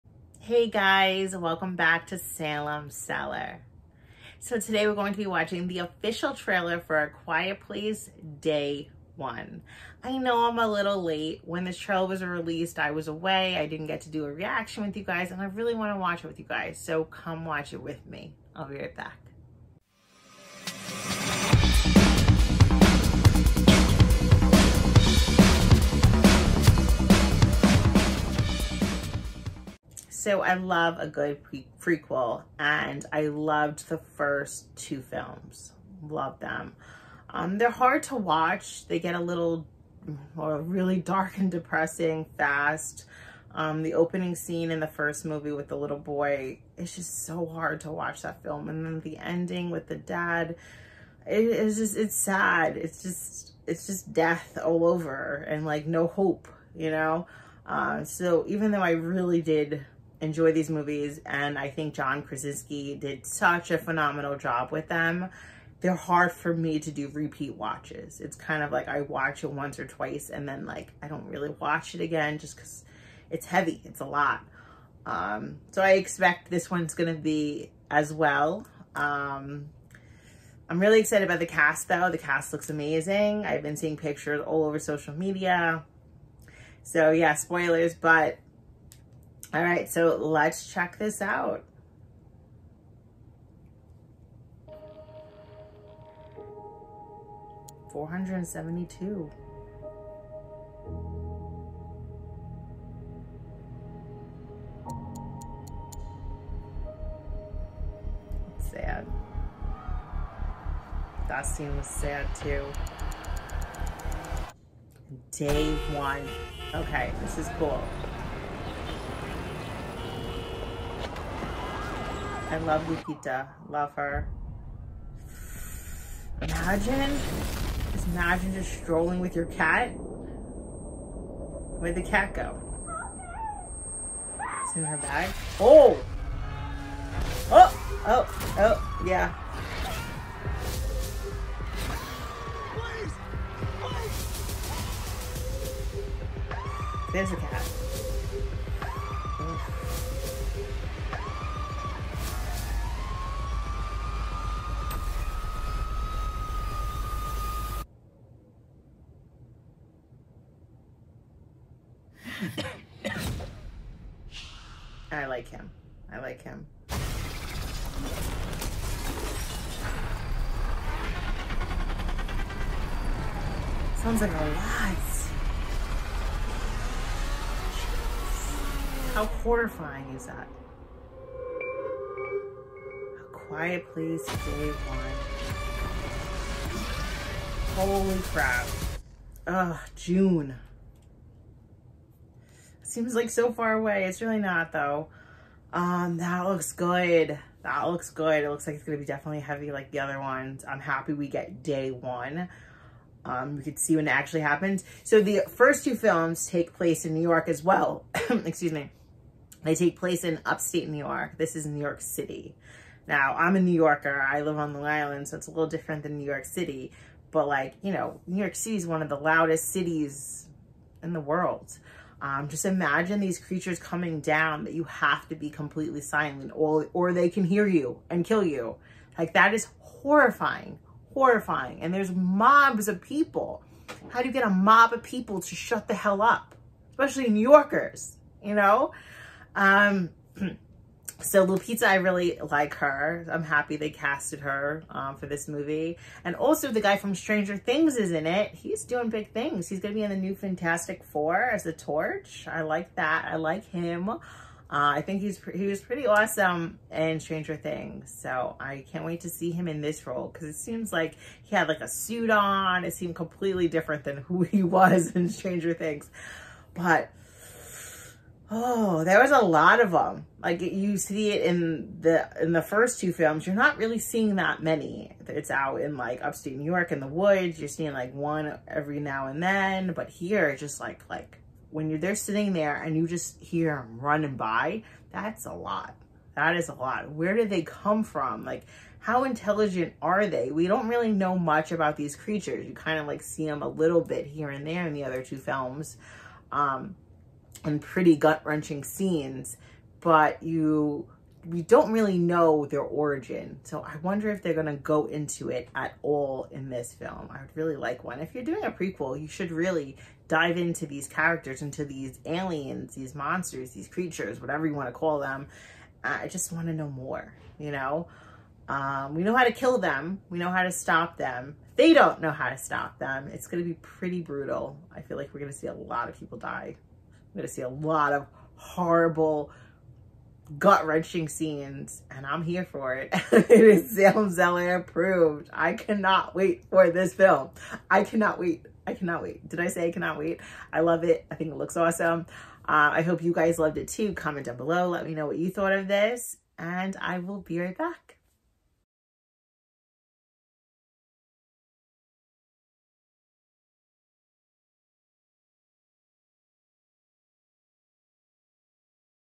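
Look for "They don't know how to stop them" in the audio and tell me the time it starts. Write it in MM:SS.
05:21.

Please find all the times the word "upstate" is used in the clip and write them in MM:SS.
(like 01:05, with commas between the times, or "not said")
03:30, 04:36.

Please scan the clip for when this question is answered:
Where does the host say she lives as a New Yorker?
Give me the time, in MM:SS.
03:34.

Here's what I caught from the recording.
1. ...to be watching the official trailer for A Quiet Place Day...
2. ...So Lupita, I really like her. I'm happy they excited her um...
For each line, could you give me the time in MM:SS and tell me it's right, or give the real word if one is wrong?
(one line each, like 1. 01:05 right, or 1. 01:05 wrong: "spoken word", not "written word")
1. 00:05 right
2. 04:01 wrong: "casted", not "excited".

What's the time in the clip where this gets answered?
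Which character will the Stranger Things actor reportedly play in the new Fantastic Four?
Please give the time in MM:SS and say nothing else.
04:11.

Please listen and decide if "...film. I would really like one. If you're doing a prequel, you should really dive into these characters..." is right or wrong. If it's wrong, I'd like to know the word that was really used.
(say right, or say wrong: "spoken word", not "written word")
right.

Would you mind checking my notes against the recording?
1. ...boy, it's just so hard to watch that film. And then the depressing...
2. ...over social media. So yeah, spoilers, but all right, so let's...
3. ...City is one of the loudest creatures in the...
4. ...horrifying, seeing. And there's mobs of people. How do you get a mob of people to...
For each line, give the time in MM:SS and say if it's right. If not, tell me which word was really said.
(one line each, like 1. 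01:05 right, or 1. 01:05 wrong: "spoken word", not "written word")
1. 00:45 wrong: "ending", not "depressing"
2. 01:24 right
3. 03:38 wrong: "cities", not "creatures"
4. 03:49 wrong: "horrifying", not "seeing".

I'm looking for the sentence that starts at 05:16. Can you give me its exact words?
I just want to know more, you know?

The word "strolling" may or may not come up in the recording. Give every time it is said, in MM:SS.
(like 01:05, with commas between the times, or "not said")
02:08.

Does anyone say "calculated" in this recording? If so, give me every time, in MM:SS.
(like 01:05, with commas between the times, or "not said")
not said.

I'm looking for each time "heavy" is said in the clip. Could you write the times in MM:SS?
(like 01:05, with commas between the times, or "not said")
01:13, 03:19.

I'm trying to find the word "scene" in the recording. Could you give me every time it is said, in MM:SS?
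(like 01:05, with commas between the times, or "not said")
00:44, 01:51, 04:58, 05:31.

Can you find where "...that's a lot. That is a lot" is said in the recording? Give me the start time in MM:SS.
04:45.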